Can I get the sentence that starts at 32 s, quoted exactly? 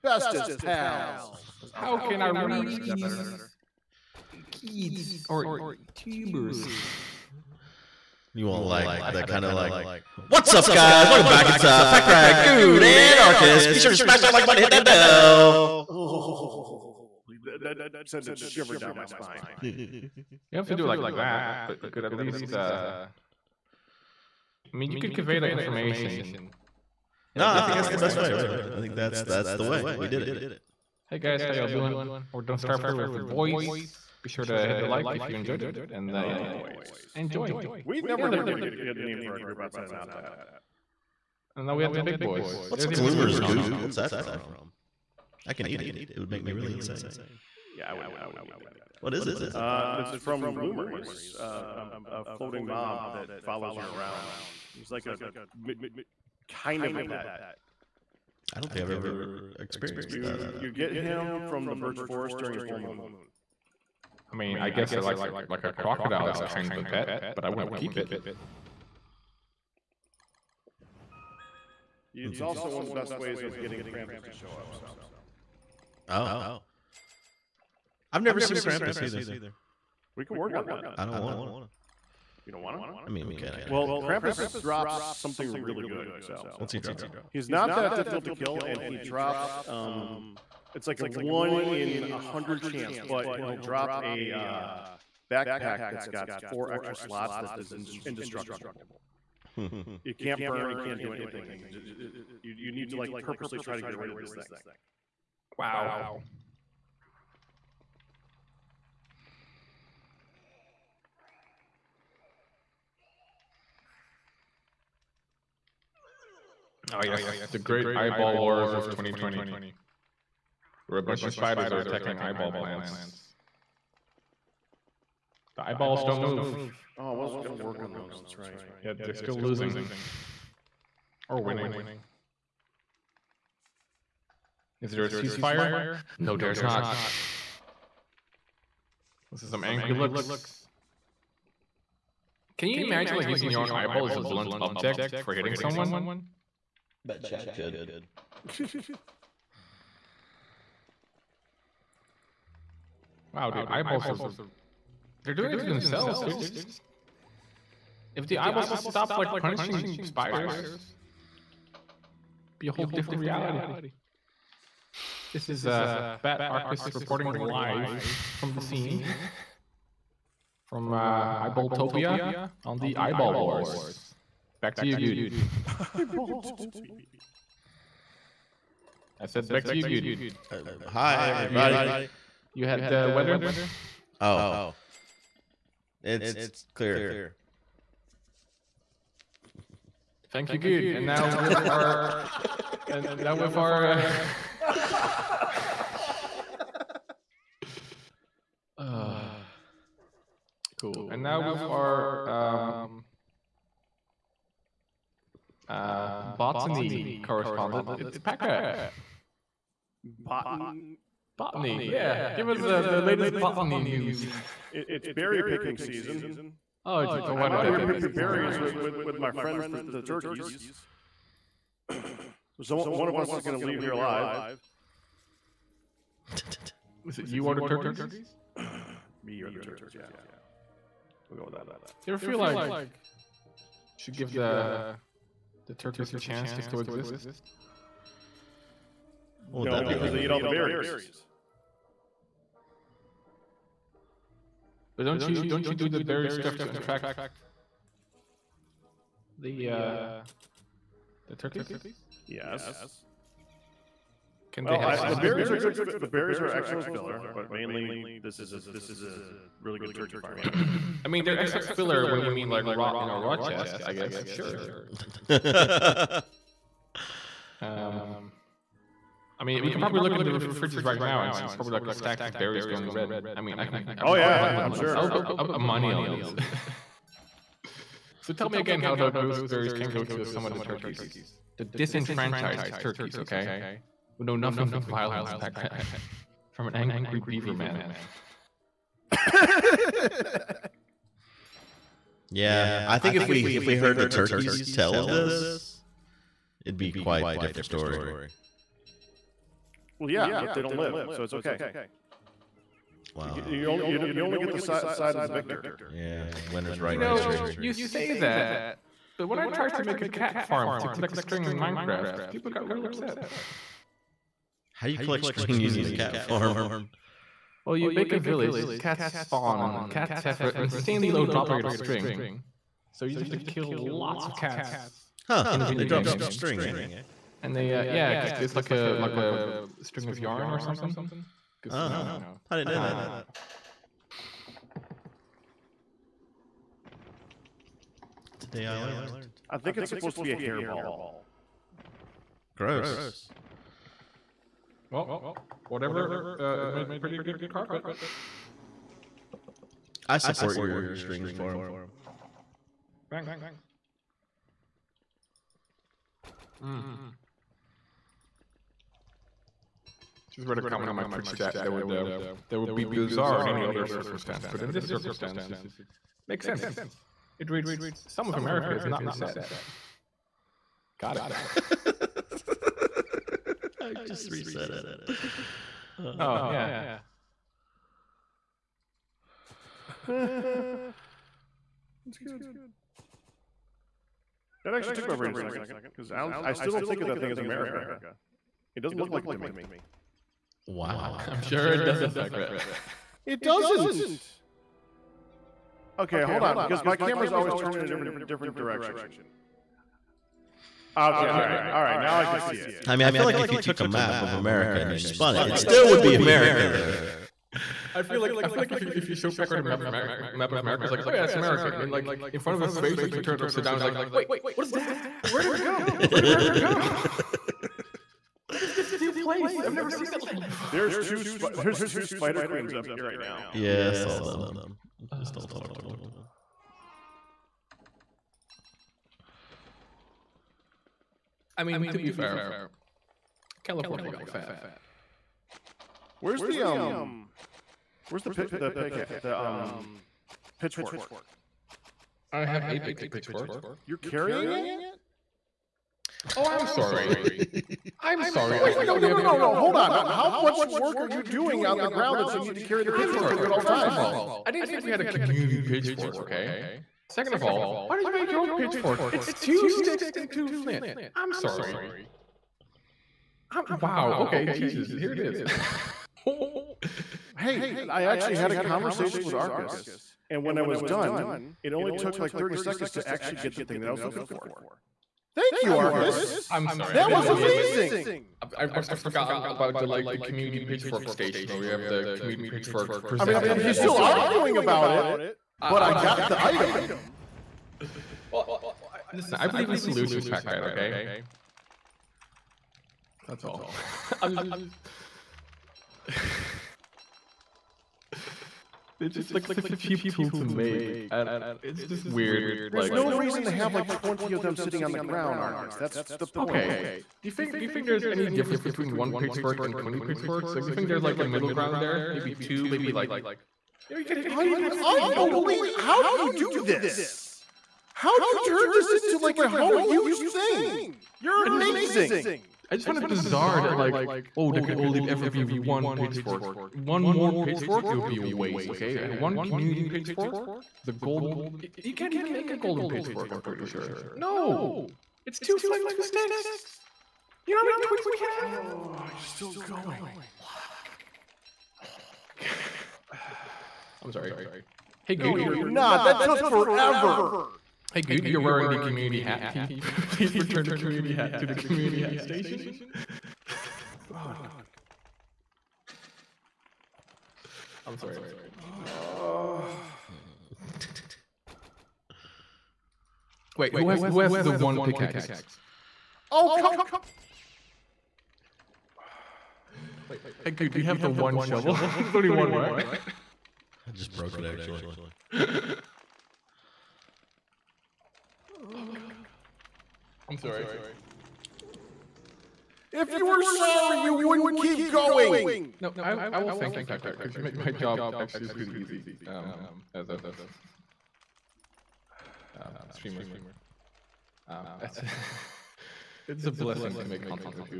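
We're done Starfire here with the boys.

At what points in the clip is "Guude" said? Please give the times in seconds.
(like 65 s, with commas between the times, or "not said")
12 s, 174 s, 179 s, 548 s, 570 s.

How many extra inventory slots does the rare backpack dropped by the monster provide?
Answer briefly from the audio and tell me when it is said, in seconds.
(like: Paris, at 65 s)
4, at 96 s.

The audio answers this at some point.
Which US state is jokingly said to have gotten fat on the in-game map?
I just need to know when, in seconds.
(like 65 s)
433 s.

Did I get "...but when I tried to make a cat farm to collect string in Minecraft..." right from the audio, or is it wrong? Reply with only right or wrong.
right.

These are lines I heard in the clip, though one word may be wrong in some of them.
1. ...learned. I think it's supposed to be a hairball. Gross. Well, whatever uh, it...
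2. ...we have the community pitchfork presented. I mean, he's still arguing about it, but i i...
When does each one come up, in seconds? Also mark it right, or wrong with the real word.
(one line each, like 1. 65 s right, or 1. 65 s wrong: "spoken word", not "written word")
1. 338 s right
2. 481 s right.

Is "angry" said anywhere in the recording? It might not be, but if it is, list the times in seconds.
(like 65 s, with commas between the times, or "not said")
139 s, 286 s.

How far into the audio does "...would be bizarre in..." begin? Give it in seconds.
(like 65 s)
362 s.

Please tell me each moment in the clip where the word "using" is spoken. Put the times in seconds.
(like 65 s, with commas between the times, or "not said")
143 s, 315 s.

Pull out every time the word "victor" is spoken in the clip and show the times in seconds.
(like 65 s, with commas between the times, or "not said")
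305 s.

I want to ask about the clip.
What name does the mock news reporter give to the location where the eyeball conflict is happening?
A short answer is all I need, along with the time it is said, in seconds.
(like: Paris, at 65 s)
Eyeballtopia, at 171 s.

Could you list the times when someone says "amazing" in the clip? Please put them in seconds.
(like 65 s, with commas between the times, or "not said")
477 s, 521 s.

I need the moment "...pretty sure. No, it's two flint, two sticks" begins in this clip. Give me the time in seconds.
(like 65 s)
533 s.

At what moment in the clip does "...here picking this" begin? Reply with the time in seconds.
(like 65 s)
217 s.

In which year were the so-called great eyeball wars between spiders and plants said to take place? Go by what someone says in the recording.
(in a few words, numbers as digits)
2020.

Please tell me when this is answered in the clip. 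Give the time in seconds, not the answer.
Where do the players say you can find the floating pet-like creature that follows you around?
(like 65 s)
61 s.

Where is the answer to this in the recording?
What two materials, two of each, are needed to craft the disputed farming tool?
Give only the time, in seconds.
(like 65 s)
459 s.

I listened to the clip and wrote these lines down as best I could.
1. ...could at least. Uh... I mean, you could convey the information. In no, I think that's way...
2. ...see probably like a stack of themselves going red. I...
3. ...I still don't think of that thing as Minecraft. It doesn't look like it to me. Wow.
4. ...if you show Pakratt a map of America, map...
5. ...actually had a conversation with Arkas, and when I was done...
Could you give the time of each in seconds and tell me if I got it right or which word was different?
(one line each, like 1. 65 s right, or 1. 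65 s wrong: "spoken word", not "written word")
1. 21 s right
2. 271 s wrong: "berries", not "themselves"
3. 386 s wrong: "America", not "Minecraft"
4. 408 s right
5. 468 s right.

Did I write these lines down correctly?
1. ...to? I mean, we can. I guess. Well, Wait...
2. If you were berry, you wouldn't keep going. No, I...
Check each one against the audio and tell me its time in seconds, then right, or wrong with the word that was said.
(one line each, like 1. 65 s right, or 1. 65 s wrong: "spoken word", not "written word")
1. 82 s wrong: "Krampus", not "Wait"
2. 582 s wrong: "sorry", not "berry".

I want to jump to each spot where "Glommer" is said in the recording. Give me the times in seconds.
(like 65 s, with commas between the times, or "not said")
42 s, 50 s.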